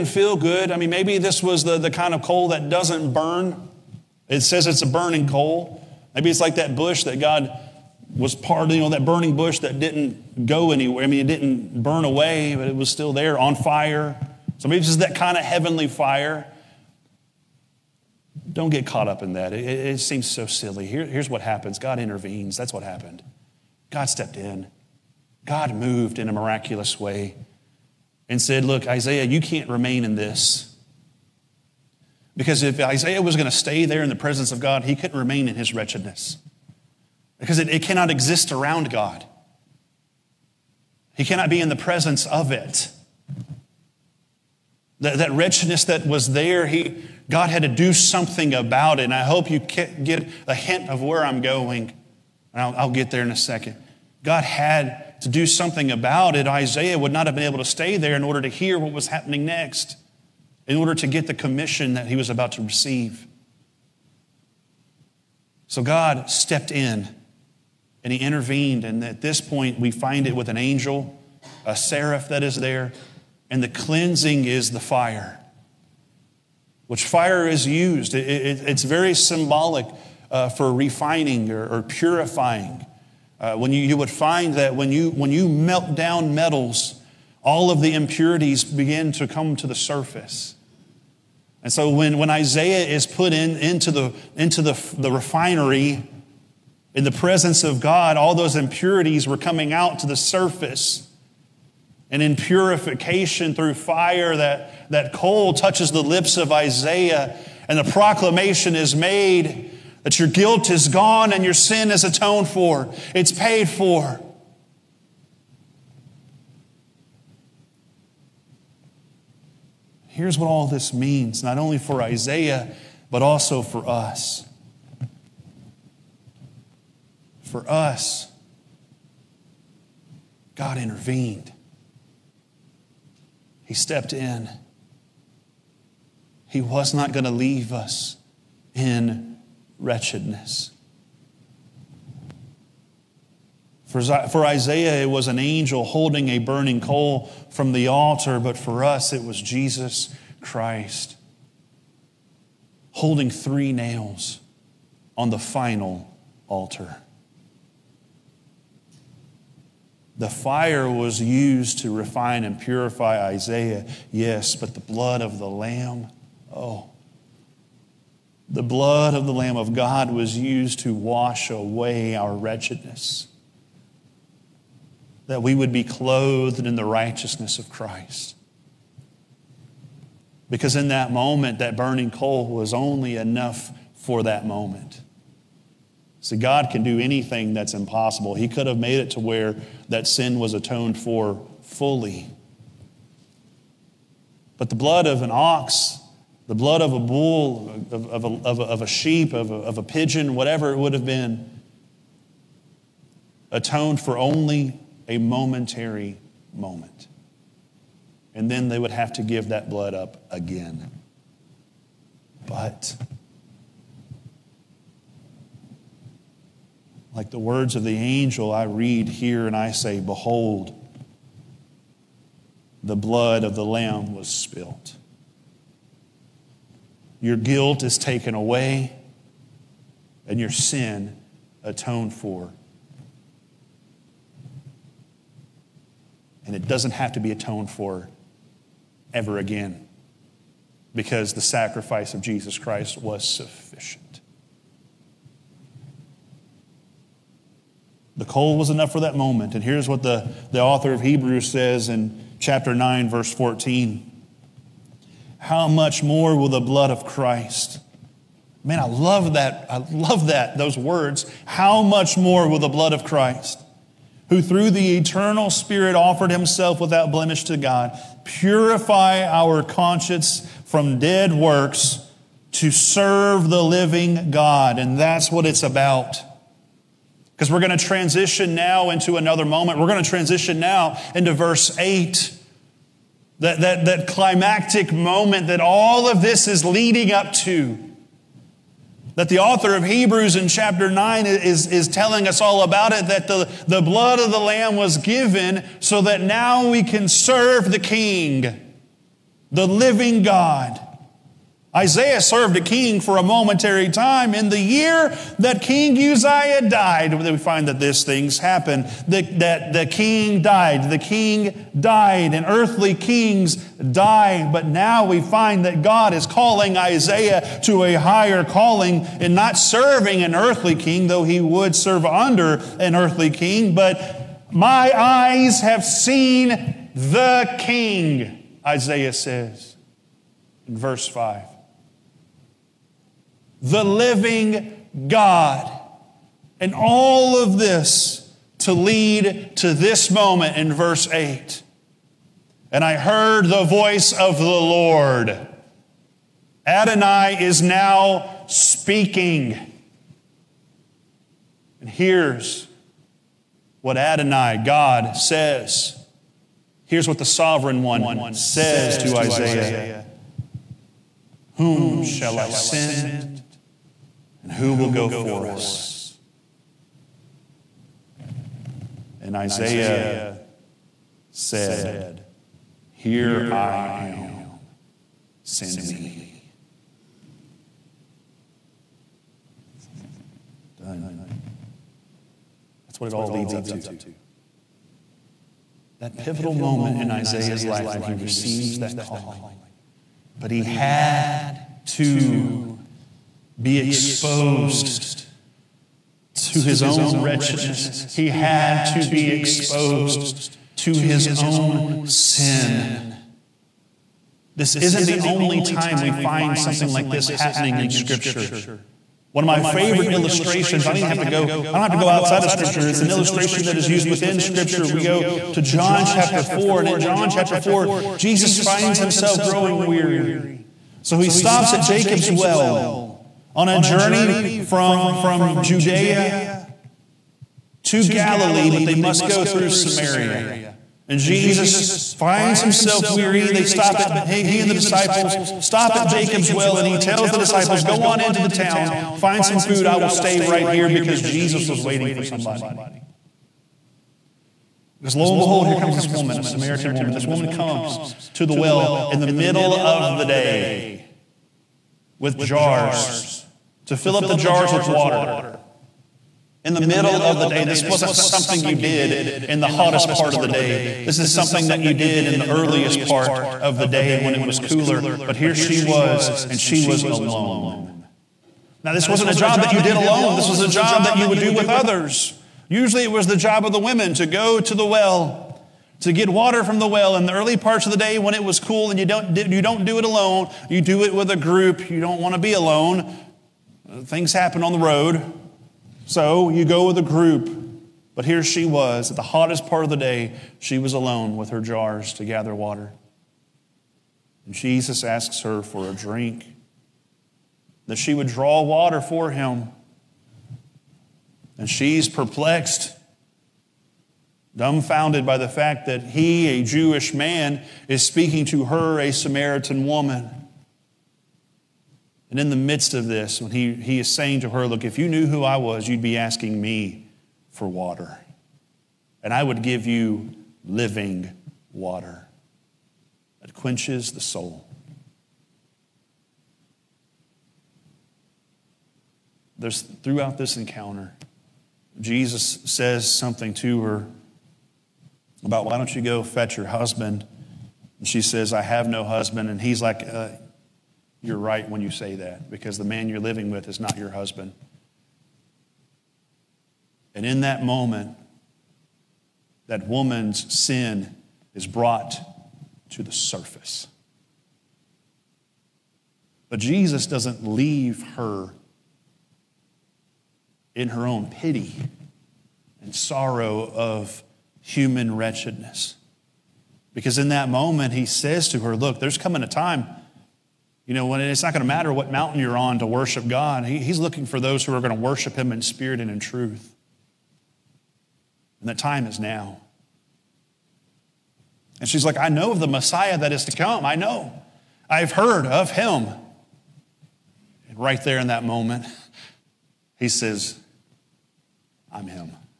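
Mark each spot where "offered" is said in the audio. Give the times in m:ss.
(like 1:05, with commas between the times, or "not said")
4:25.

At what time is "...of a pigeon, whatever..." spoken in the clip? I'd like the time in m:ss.
3:19.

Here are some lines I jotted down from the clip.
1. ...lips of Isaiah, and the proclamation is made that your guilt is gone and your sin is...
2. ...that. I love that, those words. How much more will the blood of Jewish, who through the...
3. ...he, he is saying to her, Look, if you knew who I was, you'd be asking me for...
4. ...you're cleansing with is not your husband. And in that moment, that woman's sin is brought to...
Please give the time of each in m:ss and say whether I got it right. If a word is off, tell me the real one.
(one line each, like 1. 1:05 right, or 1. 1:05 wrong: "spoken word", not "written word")
1. 1:46 right
2. 4:19 wrong: "Christ", not "Jewish"
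3. 8:33 right
4. 9:03 wrong: "living", not "cleansing".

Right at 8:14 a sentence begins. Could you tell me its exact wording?
And Jesus asks her for a drink, that she would draw water for him.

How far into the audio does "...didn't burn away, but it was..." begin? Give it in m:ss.
0:11.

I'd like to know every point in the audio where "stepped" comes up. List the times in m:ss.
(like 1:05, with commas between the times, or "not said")
0:24, 1:06, 2:13.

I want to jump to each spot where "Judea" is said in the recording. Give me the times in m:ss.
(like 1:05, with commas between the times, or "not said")
7:05.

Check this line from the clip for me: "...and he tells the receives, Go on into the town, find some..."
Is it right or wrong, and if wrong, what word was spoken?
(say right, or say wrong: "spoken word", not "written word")
wrong: "disciples", not "receives".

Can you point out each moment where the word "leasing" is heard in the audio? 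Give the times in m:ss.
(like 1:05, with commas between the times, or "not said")
not said.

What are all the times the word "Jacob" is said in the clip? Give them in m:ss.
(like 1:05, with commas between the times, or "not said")
7:01, 7:16.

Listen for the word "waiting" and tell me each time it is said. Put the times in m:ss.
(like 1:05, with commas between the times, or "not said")
7:21.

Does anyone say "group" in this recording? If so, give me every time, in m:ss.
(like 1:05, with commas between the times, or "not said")
8:01, 8:07.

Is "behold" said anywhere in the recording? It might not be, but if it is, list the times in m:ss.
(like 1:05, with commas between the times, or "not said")
3:40, 7:25.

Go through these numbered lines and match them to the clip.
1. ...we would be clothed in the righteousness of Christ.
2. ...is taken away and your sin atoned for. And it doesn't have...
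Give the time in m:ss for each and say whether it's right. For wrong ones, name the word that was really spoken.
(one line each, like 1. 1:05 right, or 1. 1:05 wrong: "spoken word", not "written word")
1. 2:55 right
2. 3:47 right.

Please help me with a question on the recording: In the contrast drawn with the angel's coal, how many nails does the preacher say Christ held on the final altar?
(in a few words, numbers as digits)
3.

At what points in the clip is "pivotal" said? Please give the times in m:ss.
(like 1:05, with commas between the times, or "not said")
6:26.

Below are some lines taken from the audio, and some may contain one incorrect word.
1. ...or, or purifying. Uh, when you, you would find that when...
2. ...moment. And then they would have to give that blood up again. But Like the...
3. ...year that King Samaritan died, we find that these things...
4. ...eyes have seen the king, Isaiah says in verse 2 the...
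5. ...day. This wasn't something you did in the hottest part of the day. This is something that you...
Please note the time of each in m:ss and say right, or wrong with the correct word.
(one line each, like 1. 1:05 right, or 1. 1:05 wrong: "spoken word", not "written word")
1. 1:21 right
2. 3:26 right
3. 5:04 wrong: "Uzziah", not "Samaritan"
4. 5:24 wrong: "5", not "2"
5. 7:37 right.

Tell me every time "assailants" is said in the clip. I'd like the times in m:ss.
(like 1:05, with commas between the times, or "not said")
not said.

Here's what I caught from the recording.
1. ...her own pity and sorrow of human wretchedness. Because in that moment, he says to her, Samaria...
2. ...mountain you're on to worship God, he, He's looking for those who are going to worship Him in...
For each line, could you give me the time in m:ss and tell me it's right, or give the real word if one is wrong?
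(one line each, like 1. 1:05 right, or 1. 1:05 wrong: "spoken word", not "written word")
1. 9:20 wrong: "Look", not "Samaria"
2. 9:32 right.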